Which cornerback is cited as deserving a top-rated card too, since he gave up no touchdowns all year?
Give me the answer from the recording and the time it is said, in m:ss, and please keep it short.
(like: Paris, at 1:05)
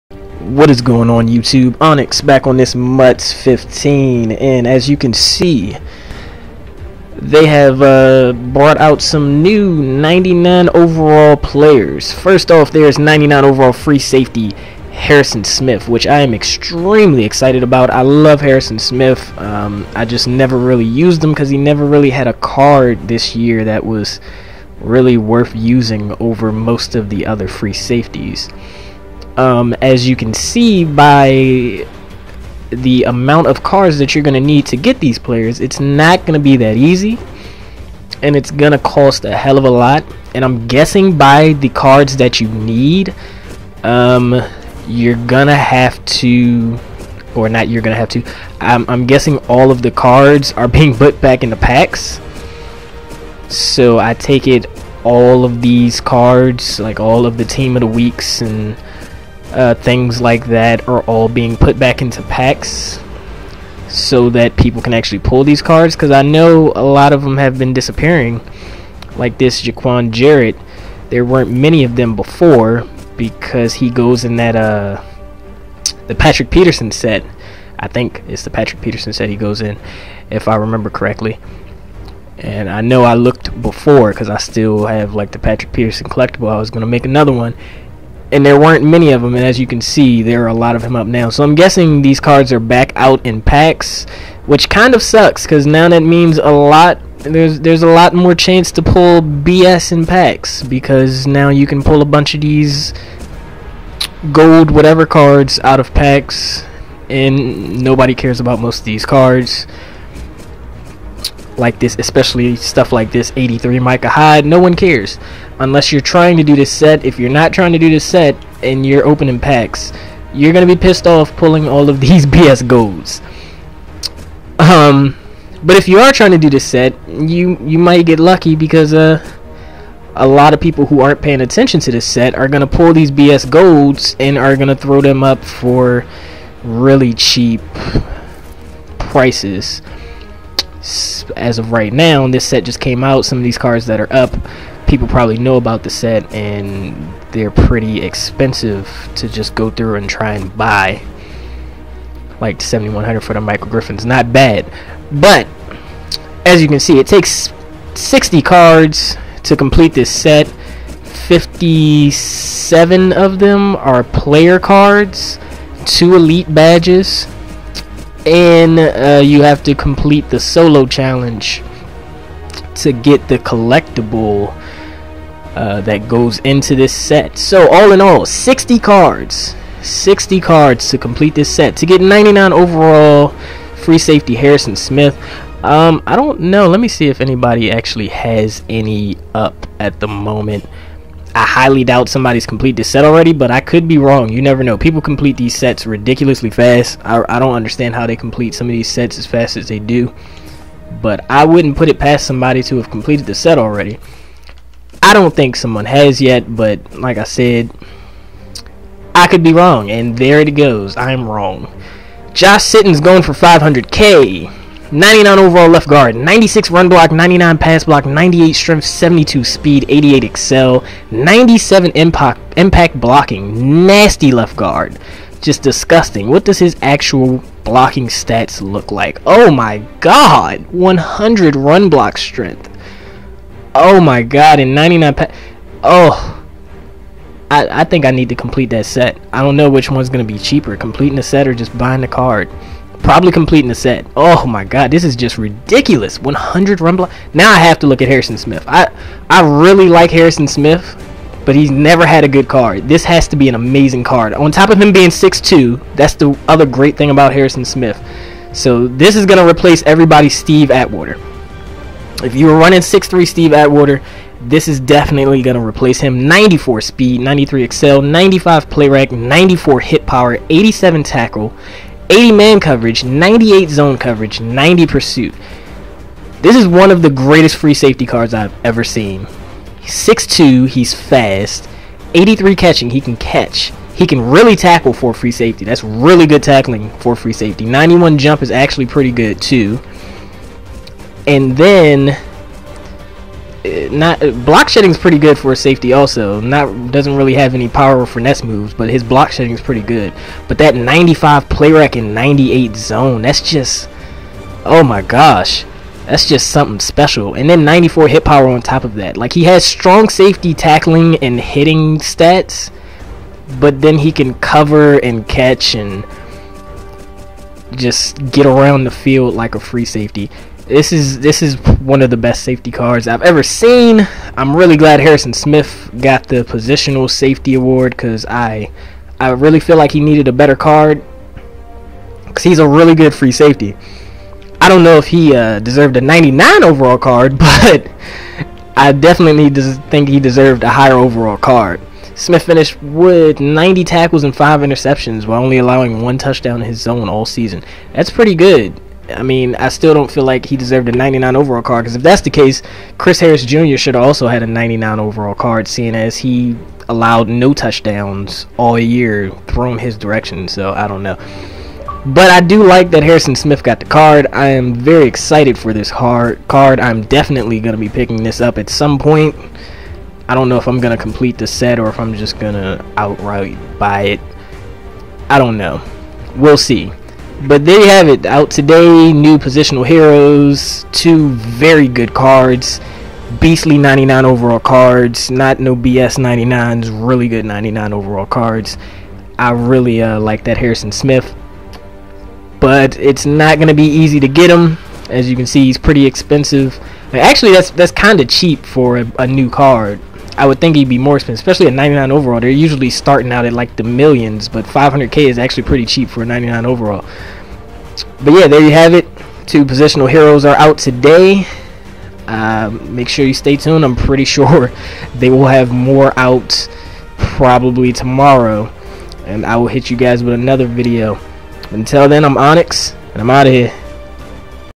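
Chris Harris Jr., at 5:52.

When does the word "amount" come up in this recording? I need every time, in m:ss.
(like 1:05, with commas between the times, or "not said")
0:33.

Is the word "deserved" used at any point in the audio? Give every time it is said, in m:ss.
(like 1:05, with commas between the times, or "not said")
5:35, 5:40, 5:50.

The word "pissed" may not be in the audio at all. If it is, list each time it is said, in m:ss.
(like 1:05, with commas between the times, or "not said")
2:00.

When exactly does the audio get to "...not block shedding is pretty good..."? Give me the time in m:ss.
4:53.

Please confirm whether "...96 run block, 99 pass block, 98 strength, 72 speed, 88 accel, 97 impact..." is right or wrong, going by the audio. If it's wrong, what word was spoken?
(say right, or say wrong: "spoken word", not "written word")
right.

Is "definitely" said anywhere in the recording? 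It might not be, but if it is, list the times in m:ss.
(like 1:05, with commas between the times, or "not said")
4:24, 5:38, 6:07.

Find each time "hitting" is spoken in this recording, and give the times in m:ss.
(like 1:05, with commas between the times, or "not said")
5:11.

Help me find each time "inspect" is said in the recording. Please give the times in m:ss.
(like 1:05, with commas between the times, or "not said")
not said.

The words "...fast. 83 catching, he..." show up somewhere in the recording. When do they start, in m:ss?
4:40.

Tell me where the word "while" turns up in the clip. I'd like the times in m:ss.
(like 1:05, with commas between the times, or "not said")
5:45.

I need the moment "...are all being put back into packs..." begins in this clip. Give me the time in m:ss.
1:00.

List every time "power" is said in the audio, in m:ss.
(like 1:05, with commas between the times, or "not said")
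4:30, 4:57, 5:08.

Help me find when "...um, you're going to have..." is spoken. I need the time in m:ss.
0:43.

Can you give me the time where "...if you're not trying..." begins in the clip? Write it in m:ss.
1:57.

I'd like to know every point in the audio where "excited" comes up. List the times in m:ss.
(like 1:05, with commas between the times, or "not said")
0:17, 6:05.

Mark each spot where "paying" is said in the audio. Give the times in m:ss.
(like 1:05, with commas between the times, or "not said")
2:11.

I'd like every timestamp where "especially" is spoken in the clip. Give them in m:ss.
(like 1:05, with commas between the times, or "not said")
1:51, 6:41.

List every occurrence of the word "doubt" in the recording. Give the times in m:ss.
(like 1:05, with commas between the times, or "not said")
3:11.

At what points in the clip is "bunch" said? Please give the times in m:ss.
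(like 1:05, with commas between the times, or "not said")
1:42.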